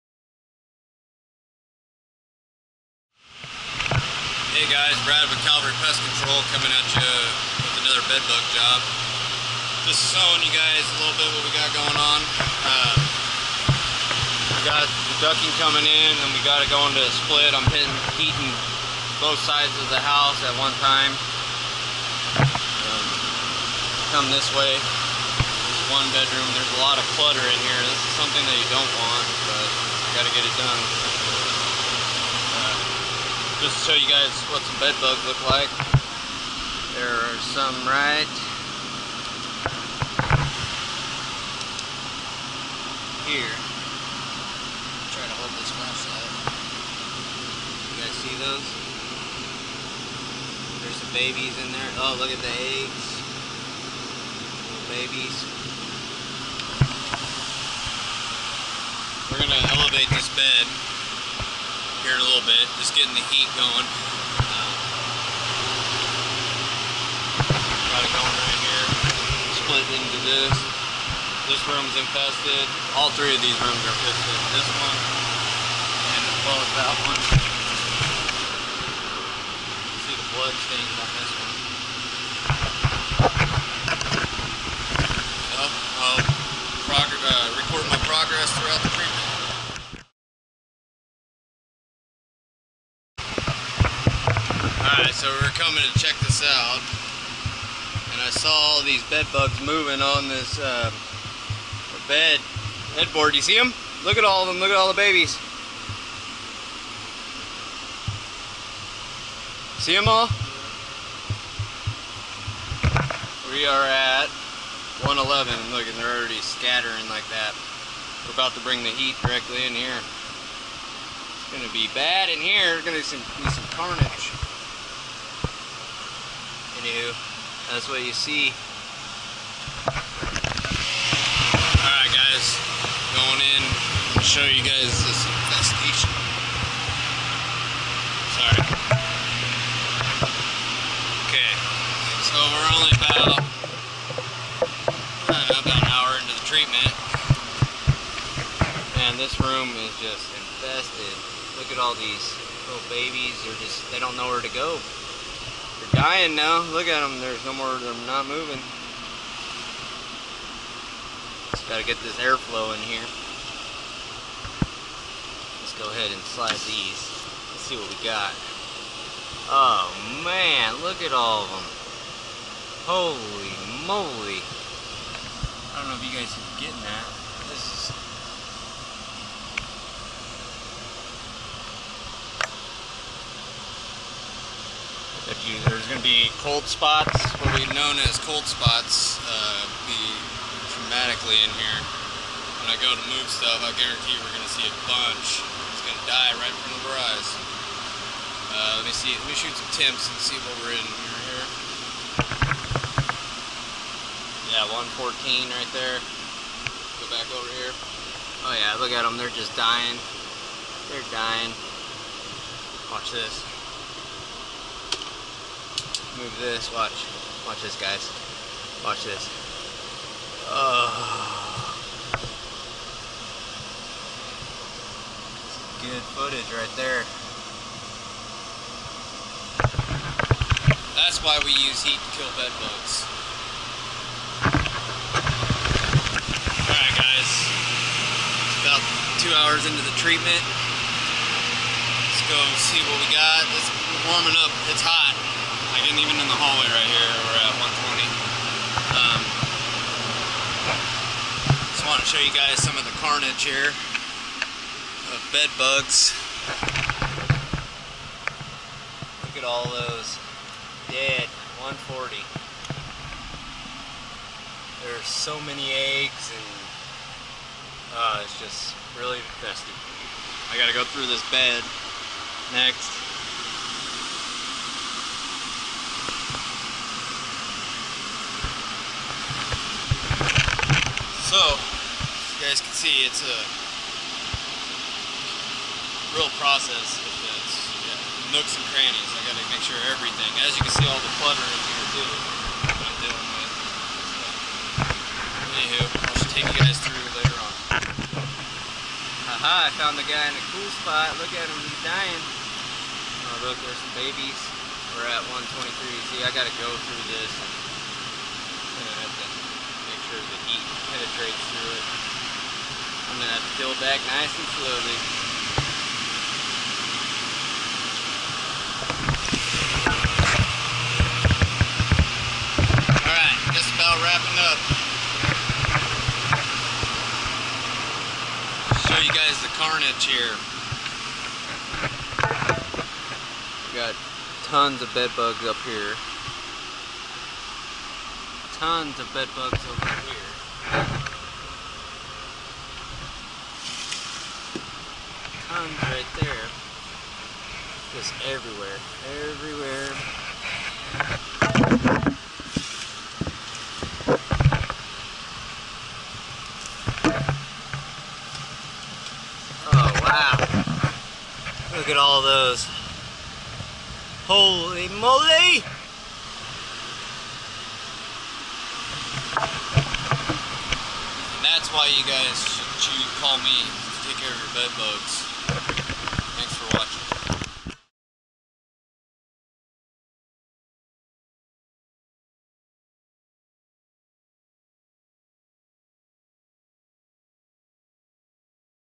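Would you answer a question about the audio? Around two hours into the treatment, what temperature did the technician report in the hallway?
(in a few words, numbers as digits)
120.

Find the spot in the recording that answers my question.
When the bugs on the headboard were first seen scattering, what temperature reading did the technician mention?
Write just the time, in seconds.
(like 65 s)
115 s.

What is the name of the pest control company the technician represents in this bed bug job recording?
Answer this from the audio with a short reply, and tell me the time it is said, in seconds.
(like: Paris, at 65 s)
Cavalry Pest Control, at 5 s.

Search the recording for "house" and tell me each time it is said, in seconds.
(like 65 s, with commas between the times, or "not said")
19 s.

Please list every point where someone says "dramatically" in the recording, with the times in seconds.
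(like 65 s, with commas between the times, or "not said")
190 s.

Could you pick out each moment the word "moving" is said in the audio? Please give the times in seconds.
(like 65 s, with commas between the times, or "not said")
99 s, 158 s.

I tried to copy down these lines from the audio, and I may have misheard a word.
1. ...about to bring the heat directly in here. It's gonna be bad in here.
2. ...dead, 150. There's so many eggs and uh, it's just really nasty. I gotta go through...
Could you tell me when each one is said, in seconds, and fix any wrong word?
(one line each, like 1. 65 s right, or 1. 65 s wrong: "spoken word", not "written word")
1. 118 s right
2. 260 s wrong: "140", not "150".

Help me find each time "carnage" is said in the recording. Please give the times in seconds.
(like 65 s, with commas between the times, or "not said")
123 s, 252 s, 329 s.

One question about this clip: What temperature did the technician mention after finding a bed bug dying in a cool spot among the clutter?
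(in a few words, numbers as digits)
123.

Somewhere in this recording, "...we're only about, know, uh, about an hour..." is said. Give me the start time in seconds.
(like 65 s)
142 s.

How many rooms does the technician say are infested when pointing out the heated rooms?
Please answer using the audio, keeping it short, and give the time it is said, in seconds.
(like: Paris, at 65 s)
3, at 73 s.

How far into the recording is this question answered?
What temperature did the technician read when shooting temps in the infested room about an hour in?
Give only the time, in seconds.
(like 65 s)
204 s.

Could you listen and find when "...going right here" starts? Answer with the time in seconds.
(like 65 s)
68 s.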